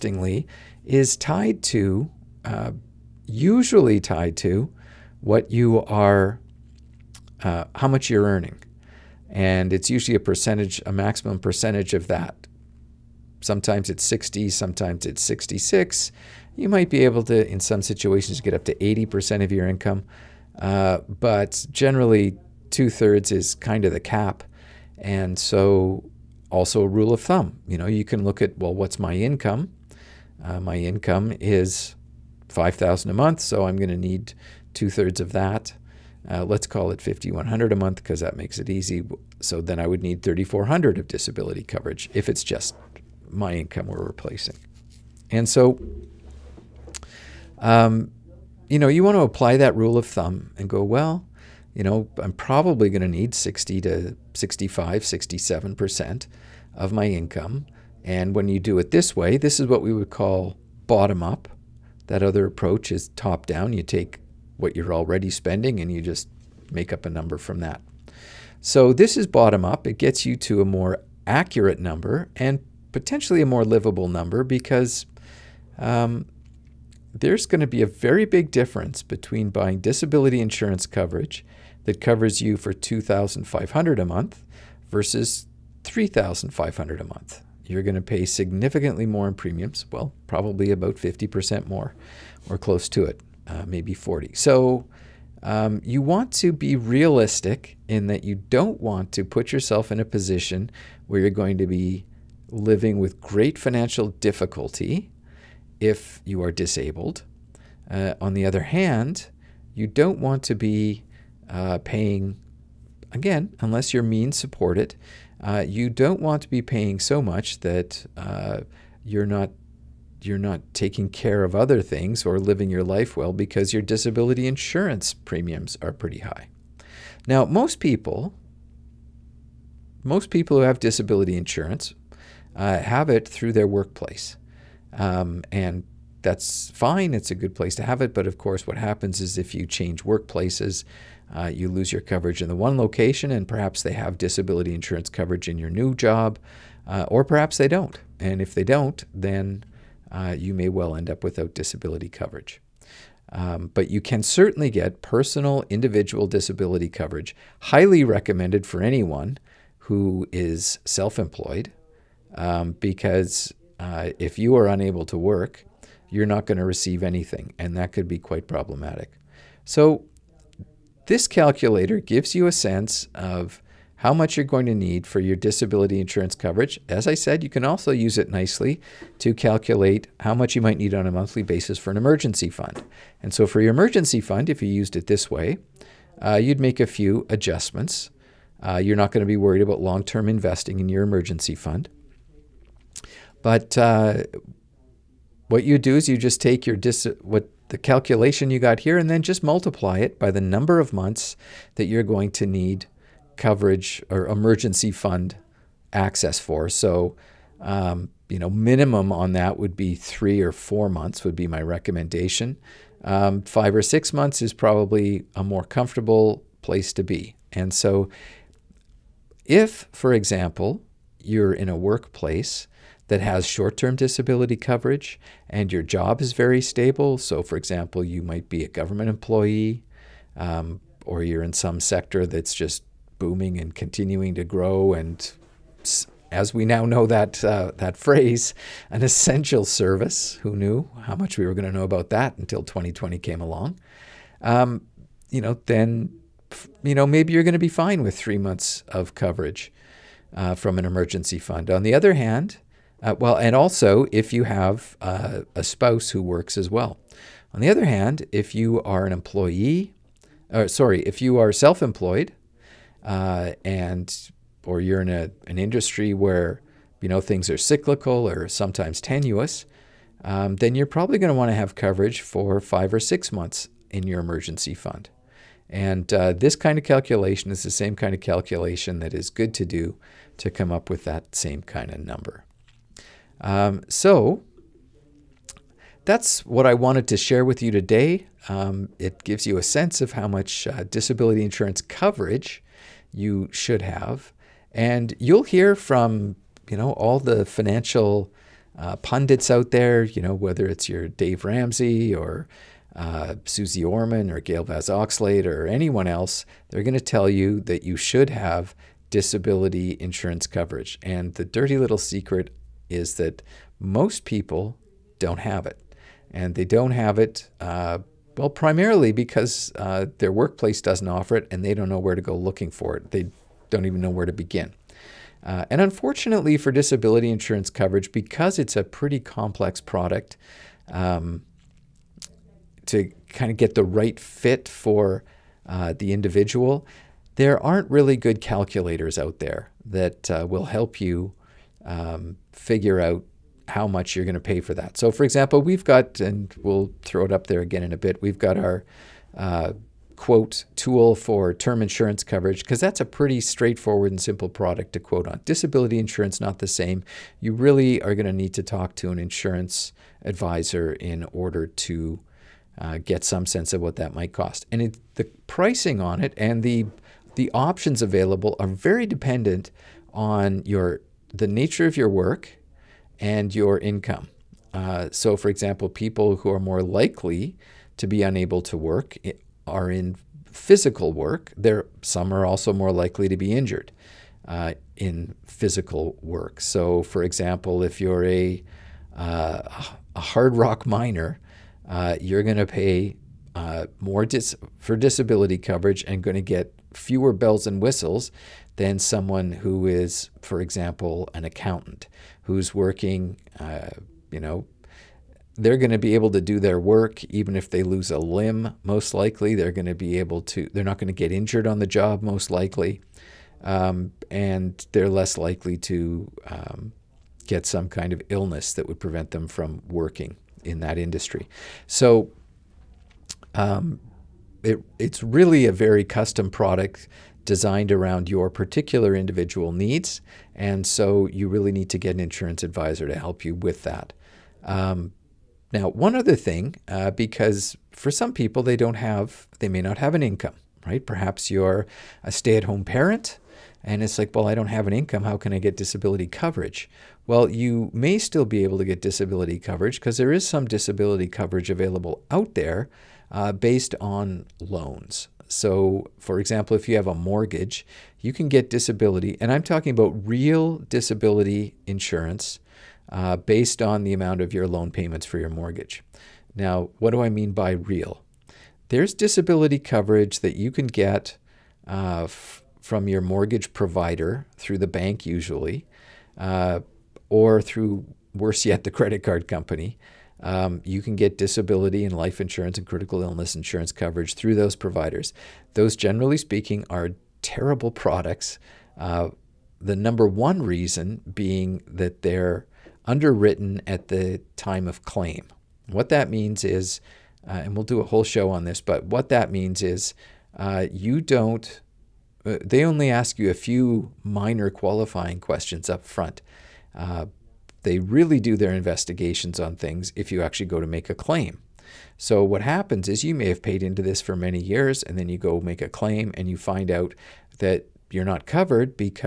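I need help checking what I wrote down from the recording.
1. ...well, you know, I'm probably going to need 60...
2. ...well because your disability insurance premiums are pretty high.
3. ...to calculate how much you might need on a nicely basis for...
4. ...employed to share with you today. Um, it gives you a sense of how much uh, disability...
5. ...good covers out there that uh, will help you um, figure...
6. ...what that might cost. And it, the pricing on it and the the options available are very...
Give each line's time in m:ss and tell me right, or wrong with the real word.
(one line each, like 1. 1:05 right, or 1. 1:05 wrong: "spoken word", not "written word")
1. 0:50 right
2. 2:03 right
3. 2:59 wrong: "monthly", not "nicely"
4. 4:46 wrong: "wanted", not "employed"
5. 5:38 wrong: "calculators", not "covers"
6. 6:03 right.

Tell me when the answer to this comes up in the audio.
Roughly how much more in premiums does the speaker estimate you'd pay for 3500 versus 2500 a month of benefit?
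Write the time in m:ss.
1:30.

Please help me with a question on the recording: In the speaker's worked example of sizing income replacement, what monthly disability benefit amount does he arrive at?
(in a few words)
3400.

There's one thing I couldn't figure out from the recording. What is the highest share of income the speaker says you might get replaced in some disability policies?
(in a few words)
80%.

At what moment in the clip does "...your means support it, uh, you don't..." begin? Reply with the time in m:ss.
1:53.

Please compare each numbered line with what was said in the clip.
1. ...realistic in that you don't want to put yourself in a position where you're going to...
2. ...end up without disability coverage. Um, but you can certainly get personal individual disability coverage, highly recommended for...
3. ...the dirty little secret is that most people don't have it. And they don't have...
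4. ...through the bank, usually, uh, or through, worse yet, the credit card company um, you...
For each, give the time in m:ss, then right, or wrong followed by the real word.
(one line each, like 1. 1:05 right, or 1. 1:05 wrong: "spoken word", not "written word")
1. 1:36 right
2. 2:30 right
3. 5:11 right
4. 7:54 right.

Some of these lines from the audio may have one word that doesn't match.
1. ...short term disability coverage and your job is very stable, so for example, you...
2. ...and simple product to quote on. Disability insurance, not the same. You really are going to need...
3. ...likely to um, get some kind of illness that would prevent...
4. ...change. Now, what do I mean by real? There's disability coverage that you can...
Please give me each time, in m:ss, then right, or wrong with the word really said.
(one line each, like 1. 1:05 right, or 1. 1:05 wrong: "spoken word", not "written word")
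1. 3:43 right
2. 5:54 right
3. 6:55 right
4. 7:45 wrong: "mortgage", not "change".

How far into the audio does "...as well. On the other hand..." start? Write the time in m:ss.
4:16.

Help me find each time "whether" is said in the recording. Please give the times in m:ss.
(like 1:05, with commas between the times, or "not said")
5:00.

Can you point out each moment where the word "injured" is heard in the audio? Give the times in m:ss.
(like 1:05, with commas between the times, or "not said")
6:23, 6:51.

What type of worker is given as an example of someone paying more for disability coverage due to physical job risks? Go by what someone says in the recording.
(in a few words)
hard rock miner.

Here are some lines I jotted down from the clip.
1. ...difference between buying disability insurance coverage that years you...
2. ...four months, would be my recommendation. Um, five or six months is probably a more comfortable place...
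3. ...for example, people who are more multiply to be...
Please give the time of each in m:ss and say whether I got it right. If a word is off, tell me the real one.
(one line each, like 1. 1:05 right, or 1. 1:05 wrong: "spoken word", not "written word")
1. 1:18 wrong: "covers", not "years"
2. 3:30 right
3. 6:15 wrong: "likely", not "multiply".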